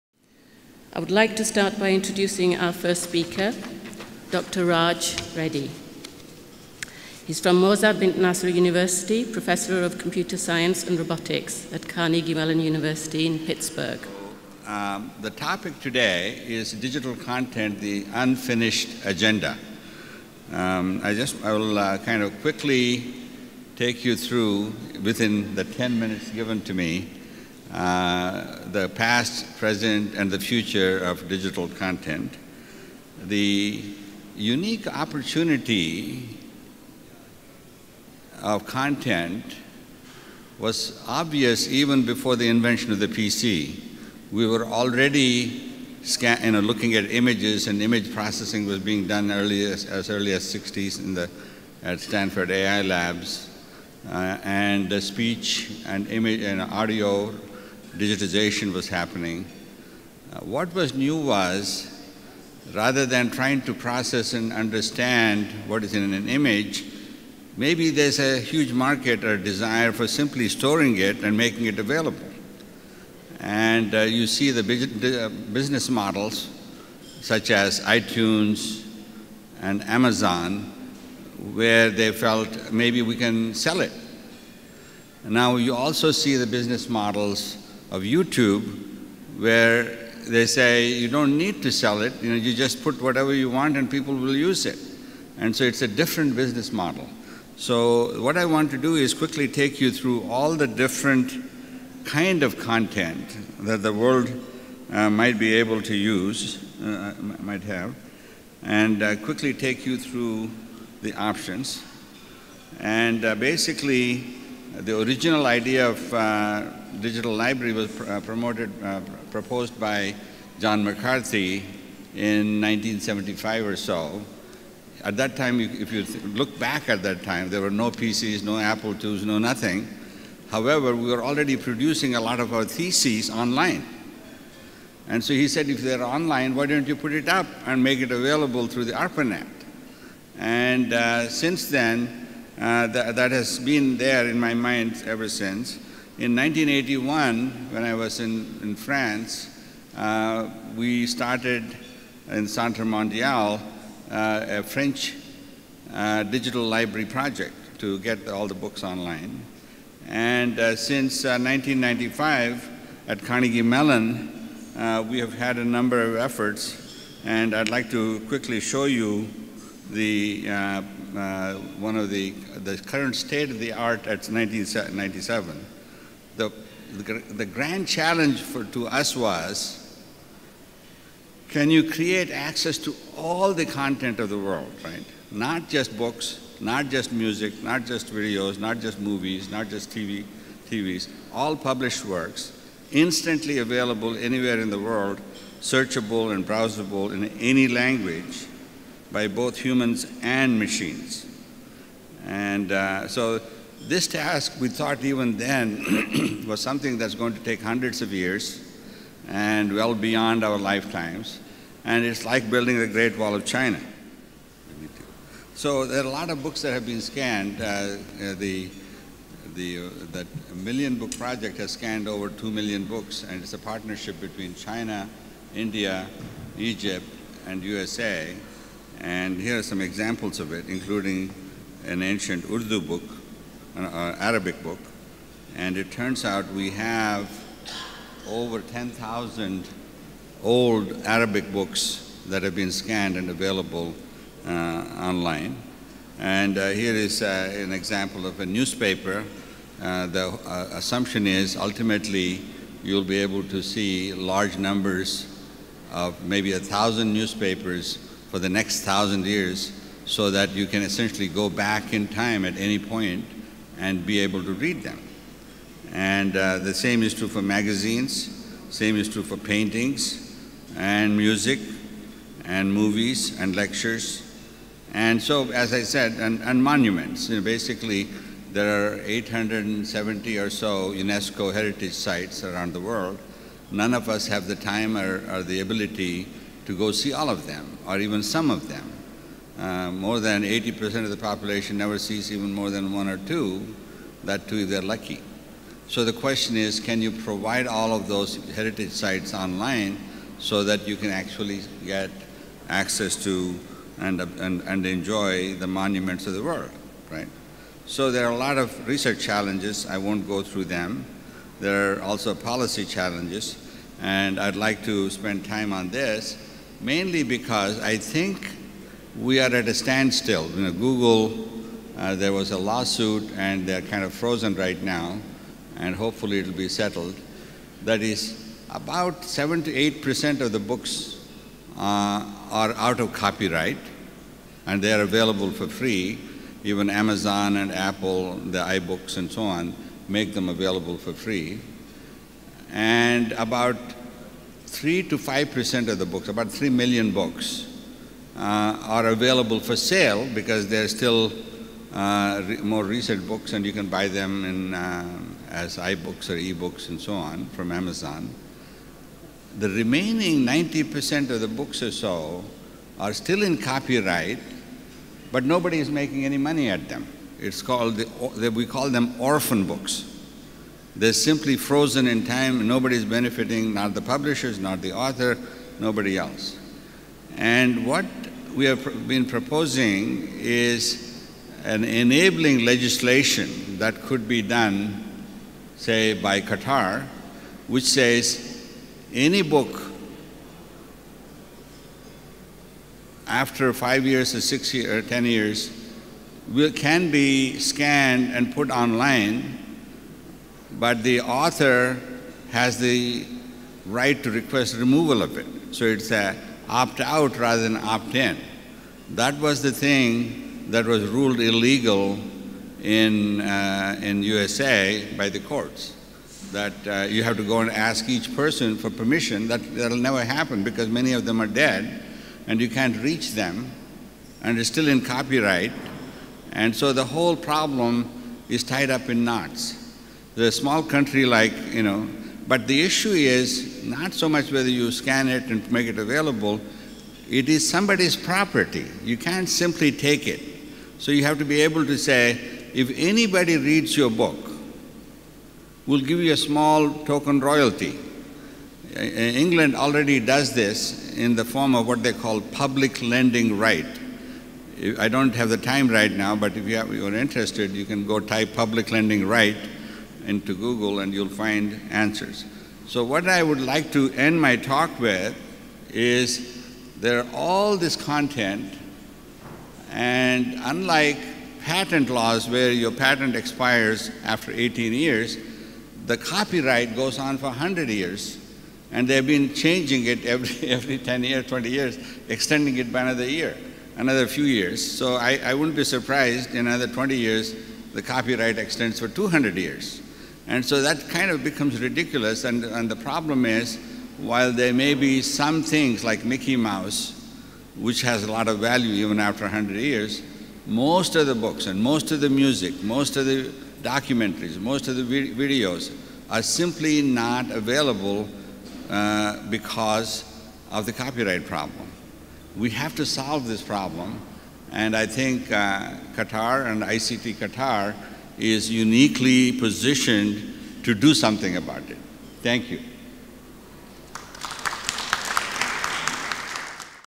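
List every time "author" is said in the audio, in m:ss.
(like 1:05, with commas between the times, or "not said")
6:14, 6:41.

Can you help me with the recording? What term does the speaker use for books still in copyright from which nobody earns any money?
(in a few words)
orphan books.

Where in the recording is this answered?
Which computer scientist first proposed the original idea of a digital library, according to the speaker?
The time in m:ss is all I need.
2:00.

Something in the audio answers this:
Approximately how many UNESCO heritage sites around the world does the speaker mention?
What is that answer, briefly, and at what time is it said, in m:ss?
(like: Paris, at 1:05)
870, at 4:39.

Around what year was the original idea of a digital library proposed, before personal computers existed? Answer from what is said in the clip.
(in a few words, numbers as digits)
1975.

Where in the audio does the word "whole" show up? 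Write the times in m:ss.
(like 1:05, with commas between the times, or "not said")
7:07.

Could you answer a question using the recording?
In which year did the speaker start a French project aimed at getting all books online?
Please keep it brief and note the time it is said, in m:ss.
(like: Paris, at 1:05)
1981, at 2:26.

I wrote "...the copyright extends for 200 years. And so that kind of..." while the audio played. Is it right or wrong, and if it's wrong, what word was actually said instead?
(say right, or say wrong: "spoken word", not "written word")
right.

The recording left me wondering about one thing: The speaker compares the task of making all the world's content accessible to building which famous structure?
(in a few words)
Great Wall of China.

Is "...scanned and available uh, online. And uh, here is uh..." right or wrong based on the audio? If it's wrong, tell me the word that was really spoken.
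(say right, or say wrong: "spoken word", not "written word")
right.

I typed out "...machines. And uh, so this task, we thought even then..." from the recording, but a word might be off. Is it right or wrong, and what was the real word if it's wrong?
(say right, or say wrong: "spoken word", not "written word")
right.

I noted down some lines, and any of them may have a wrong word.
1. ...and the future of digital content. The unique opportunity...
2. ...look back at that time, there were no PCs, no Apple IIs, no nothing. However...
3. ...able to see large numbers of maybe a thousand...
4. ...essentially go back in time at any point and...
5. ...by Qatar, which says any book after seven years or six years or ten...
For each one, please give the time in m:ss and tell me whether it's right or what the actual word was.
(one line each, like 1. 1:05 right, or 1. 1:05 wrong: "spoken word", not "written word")
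1. 0:30 right
2. 2:06 right
3. 4:13 right
4. 4:20 right
5. 6:26 wrong: "five", not "seven".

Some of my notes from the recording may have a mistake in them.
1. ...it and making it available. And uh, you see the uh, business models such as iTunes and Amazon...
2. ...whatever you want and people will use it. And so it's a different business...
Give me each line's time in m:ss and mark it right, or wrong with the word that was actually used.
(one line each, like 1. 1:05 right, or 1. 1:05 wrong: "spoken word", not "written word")
1. 1:10 right
2. 1:33 right.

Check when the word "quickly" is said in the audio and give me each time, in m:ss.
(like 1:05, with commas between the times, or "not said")
0:22, 1:39, 1:49, 2:48.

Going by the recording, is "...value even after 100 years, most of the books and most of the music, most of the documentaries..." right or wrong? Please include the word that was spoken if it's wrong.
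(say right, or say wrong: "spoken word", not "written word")
right.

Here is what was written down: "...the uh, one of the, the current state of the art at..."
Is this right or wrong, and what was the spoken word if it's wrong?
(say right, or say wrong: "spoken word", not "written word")
right.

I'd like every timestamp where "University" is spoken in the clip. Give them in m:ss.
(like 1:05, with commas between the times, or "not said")
0:08, 0:12.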